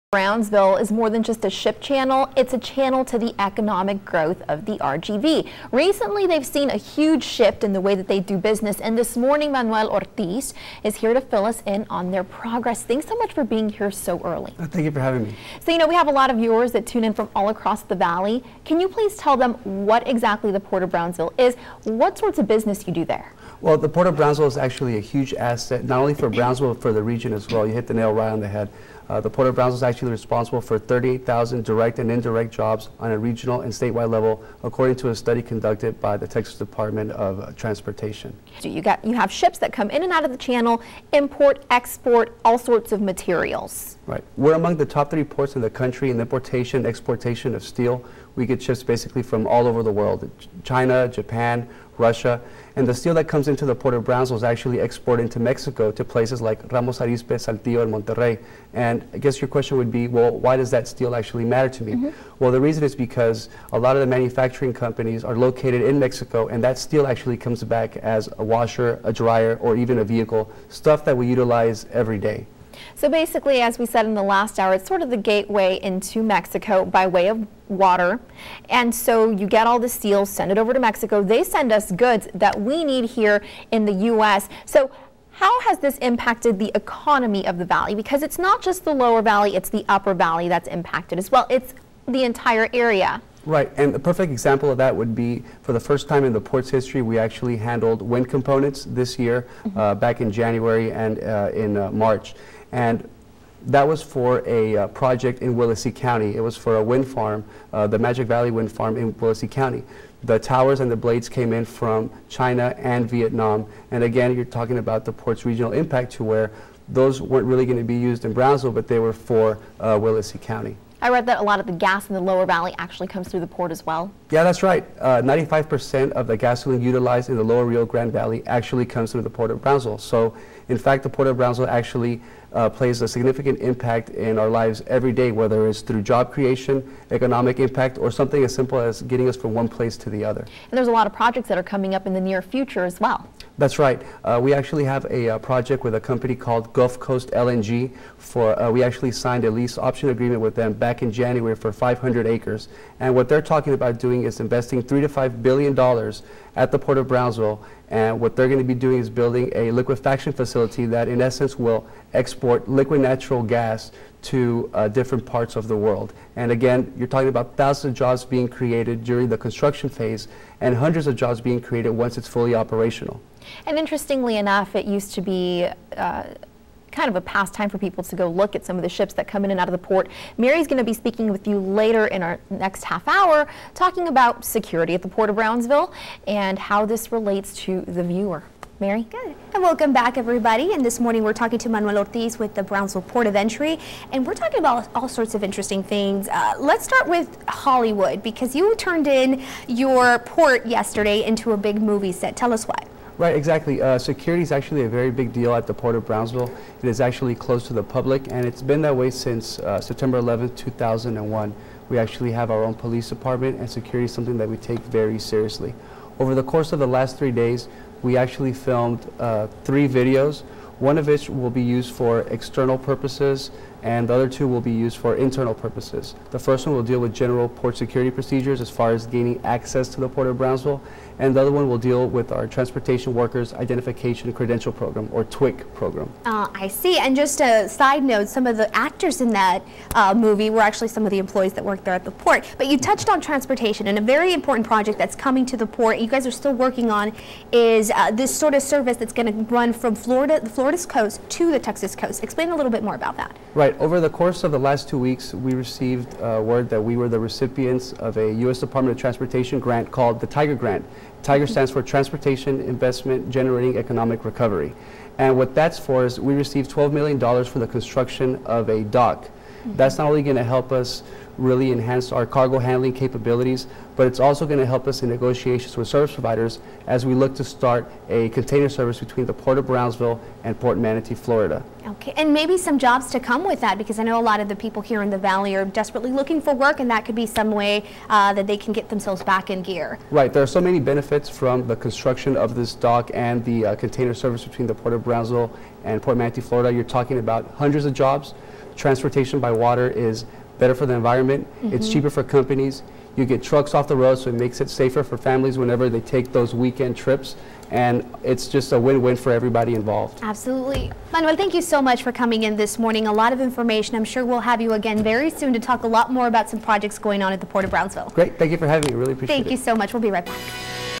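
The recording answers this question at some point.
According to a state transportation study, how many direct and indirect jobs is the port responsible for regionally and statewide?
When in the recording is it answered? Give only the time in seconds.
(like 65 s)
30 s.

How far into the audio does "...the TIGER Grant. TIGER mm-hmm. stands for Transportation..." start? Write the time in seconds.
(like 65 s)
260 s.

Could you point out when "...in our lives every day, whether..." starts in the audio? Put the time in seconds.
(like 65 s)
134 s.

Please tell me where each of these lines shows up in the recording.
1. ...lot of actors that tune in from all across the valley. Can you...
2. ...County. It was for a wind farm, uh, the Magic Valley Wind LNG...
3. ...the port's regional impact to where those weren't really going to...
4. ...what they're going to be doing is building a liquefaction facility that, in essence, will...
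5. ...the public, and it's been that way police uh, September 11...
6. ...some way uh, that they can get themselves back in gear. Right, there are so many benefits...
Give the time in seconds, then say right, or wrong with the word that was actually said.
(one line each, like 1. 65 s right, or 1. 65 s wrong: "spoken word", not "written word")
1. 16 s wrong: "viewers", not "actors"
2. 105 s wrong: "Farm", not "LNG"
3. 115 s right
4. 158 s right
5. 207 s wrong: "since", not "police"
6. 287 s right.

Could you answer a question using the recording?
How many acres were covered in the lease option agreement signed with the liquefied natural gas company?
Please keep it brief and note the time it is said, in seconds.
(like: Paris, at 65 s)
500 acres, at 151 s.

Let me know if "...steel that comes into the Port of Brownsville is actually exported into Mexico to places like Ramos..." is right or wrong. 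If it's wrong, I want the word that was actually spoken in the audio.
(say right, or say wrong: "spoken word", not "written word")
right.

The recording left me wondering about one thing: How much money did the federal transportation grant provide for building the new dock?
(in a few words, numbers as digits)
$12 million.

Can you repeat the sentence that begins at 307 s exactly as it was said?
And it's just a win-win for everybody involved.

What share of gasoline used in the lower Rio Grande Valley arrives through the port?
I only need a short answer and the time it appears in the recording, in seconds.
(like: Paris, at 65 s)
95%, at 124 s.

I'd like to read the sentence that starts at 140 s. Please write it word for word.
And there's a lot of projects that are coming up in the near future as well.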